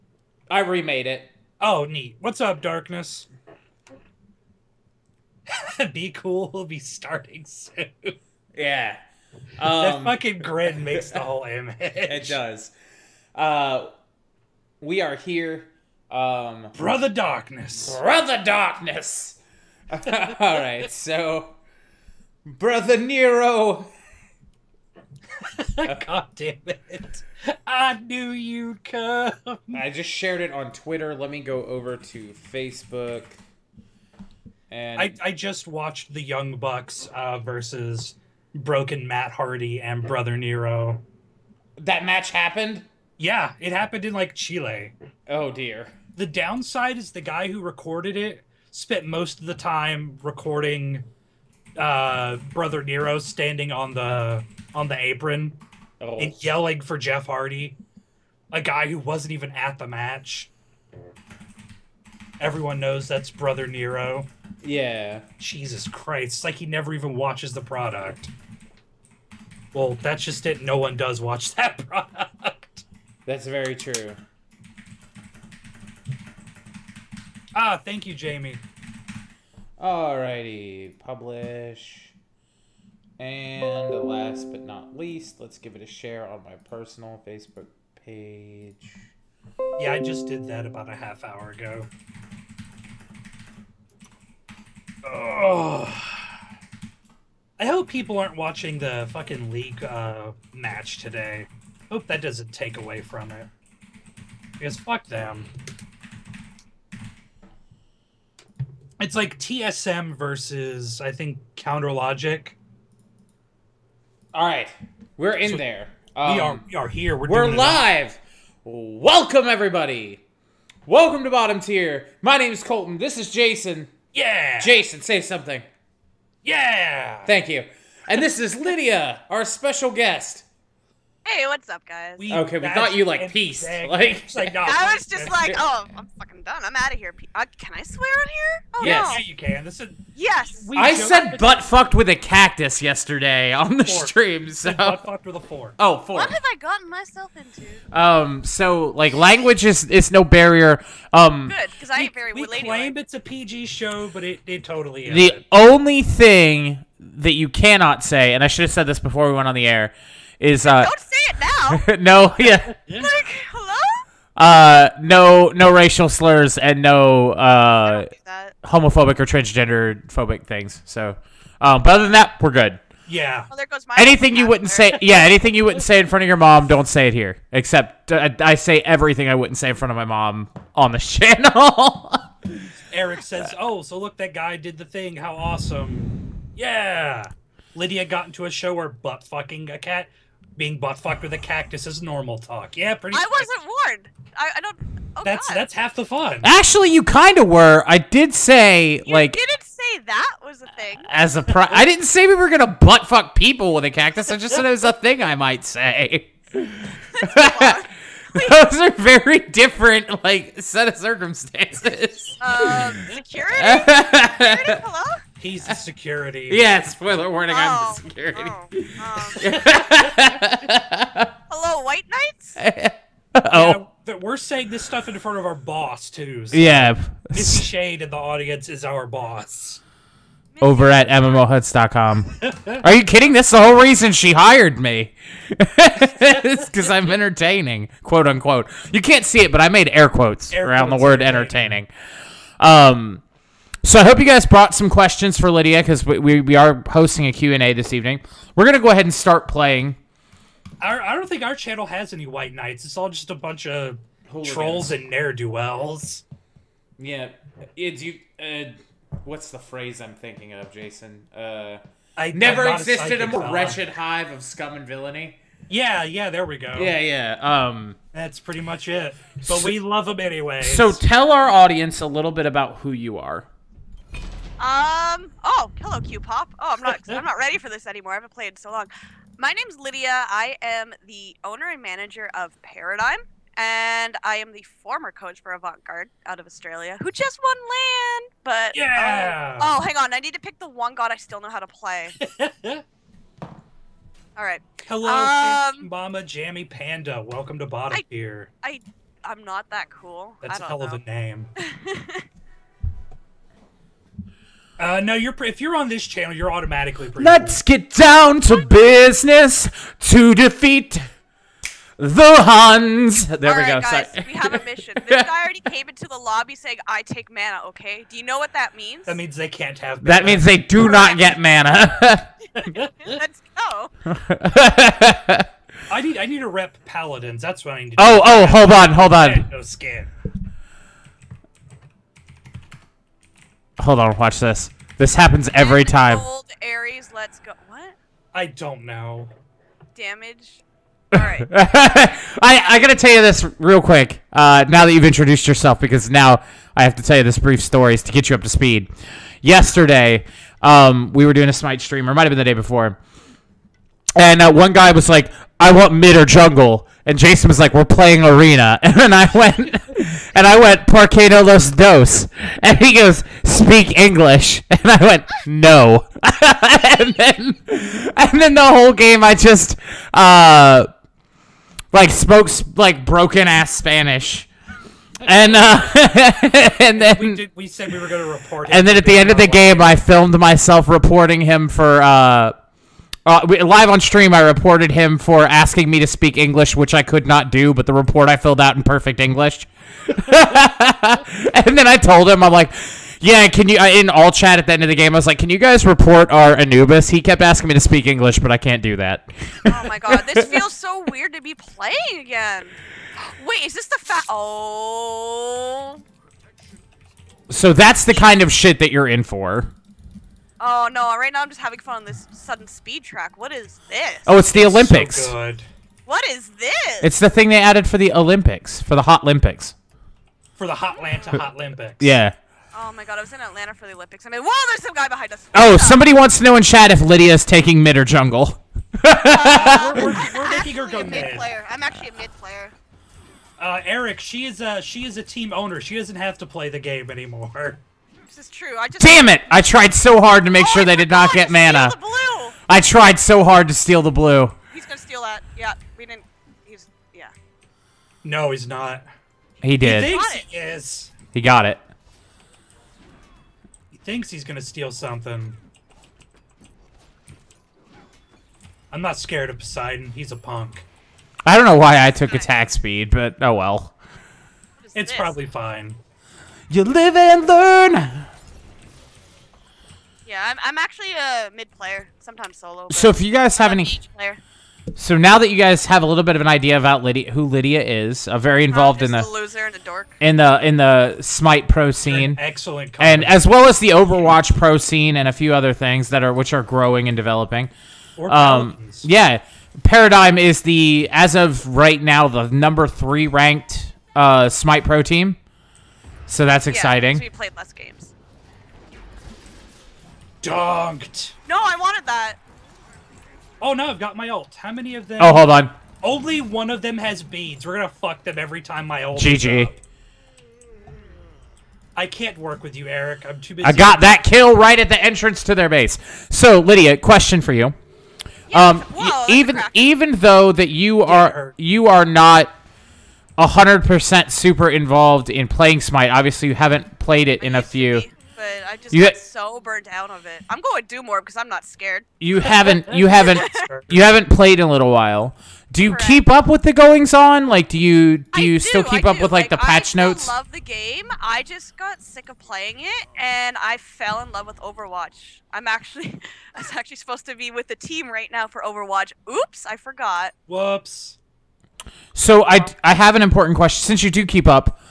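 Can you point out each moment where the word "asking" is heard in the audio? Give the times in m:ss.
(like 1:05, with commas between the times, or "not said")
6:25, 6:37.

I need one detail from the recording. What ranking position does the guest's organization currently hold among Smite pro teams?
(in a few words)
3.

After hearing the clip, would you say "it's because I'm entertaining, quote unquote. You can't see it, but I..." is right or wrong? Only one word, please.
right.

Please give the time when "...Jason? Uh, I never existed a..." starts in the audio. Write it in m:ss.
4:20.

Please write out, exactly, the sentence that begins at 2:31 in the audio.
Um, good because I ain't very.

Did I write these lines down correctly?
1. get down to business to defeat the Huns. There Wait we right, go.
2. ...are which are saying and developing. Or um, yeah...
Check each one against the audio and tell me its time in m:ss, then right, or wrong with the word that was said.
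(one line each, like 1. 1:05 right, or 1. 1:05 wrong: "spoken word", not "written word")
1. 5:07 wrong: "All", not "Wait"
2. 8:06 wrong: "growing", not "saying".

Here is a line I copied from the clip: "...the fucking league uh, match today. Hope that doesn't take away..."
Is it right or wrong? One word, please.
right.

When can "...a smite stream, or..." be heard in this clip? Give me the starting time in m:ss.
5:51.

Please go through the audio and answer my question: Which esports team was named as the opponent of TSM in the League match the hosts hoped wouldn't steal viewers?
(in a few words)
Counter Logic.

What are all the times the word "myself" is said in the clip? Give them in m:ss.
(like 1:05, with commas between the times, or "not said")
2:26, 6:20.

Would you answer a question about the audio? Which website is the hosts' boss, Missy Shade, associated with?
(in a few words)
MMOHuts.com.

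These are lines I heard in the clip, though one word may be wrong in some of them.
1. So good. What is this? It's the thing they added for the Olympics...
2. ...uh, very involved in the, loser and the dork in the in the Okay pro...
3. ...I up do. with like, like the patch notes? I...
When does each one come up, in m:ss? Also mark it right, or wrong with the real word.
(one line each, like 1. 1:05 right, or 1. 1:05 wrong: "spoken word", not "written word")
1. 6:55 right
2. 7:58 wrong: "Smite", not "Okay"
3. 8:59 right.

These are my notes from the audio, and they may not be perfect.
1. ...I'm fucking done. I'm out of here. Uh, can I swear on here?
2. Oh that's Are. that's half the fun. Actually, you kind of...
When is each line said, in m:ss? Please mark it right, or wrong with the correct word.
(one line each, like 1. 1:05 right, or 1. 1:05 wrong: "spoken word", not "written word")
1. 2:15 right
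2. 3:15 wrong: "God", not "Are".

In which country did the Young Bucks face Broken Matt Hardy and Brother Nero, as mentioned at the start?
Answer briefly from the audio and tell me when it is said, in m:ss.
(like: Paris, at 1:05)
Chile, at 0:44.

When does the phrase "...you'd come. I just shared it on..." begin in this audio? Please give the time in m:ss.
0:28.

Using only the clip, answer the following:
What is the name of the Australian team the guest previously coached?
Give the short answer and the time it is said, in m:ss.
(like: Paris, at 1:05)
Avant Garde, at 4:45.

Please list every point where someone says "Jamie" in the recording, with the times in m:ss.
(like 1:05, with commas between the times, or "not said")
1:18.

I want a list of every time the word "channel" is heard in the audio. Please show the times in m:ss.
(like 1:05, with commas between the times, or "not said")
3:00, 4:11, 5:06.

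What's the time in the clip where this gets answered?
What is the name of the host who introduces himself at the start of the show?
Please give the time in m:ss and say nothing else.
2:02.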